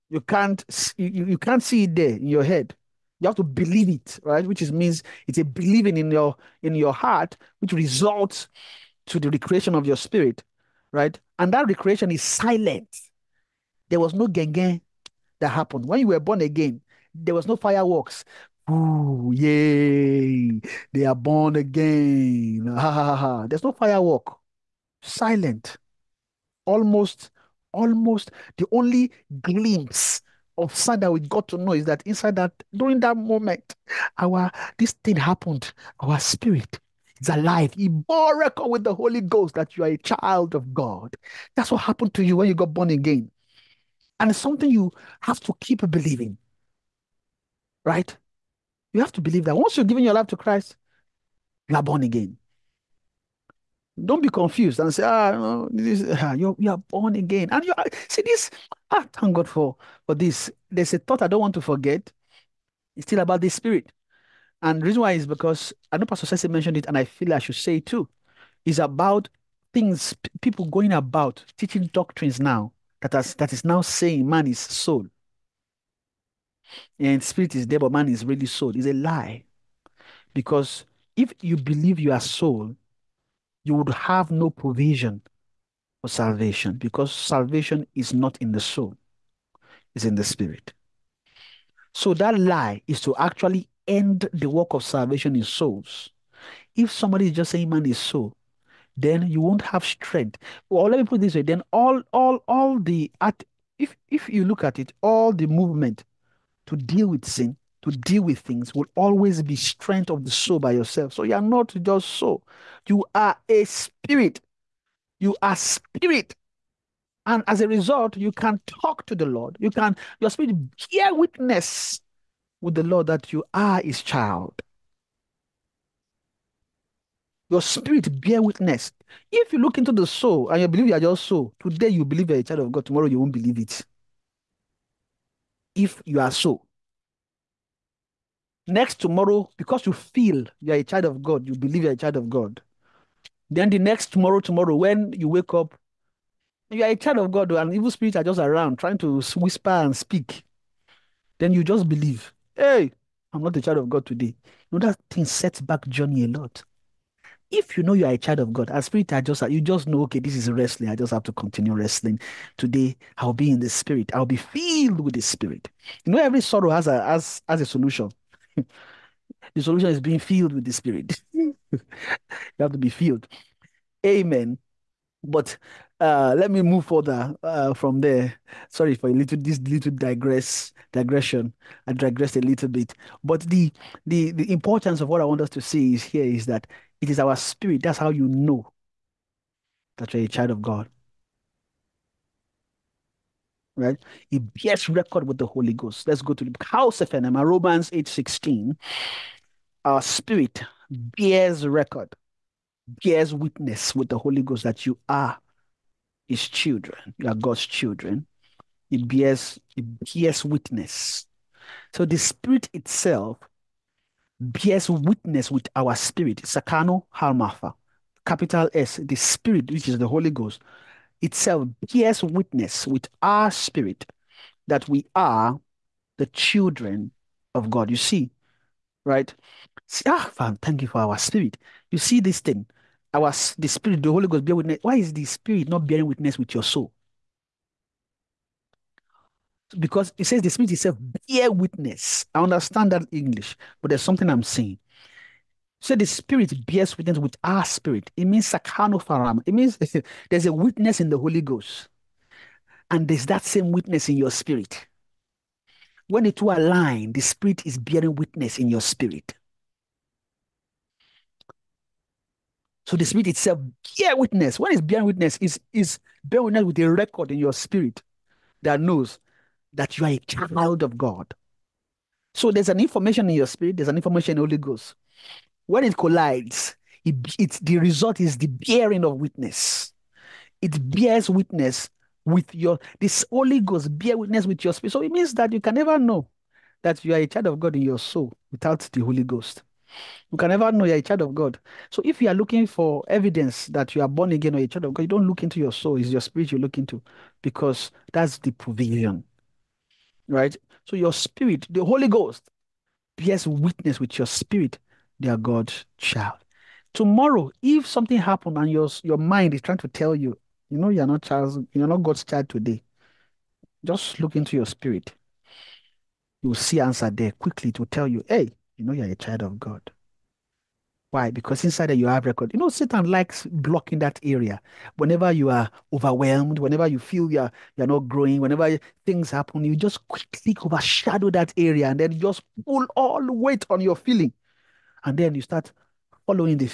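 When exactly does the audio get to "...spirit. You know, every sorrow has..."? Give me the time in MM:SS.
02:45.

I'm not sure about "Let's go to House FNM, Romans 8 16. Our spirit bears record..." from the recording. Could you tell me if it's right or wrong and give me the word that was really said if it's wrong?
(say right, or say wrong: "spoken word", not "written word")
right.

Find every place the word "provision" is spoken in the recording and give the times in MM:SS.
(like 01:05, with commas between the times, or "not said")
01:24, 04:58.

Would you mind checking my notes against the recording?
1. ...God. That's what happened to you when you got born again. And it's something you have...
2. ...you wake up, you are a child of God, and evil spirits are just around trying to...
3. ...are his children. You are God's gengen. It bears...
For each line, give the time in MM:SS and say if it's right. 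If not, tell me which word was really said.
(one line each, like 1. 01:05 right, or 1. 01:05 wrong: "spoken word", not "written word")
1. 00:40 right
2. 02:25 right
3. 03:25 wrong: "children", not "gengen".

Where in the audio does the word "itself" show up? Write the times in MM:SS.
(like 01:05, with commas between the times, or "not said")
03:32, 03:41, 04:00, 04:23.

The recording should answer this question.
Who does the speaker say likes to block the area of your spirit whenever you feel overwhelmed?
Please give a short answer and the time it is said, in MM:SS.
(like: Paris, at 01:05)
Satan, at 05:22.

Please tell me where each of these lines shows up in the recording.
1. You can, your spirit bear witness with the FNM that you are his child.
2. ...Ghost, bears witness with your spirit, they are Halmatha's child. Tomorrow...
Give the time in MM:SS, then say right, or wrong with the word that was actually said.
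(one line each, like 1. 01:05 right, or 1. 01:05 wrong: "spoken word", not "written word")
1. 01:59 wrong: "Lord", not "FNM"
2. 05:02 wrong: "God", not "Halmatha".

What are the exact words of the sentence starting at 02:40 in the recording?
I just have to continue wrestling.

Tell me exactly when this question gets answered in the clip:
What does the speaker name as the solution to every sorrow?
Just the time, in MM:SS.
02:49.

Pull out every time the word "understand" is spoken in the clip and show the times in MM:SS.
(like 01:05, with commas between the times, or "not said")
04:02.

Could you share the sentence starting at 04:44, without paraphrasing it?
So it means that you can never know that you are a child of God in your soul without the Holy Ghost.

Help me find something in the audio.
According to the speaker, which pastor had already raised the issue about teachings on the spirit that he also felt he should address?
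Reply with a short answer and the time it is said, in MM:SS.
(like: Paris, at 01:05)
Pastor Ceci, at 01:06.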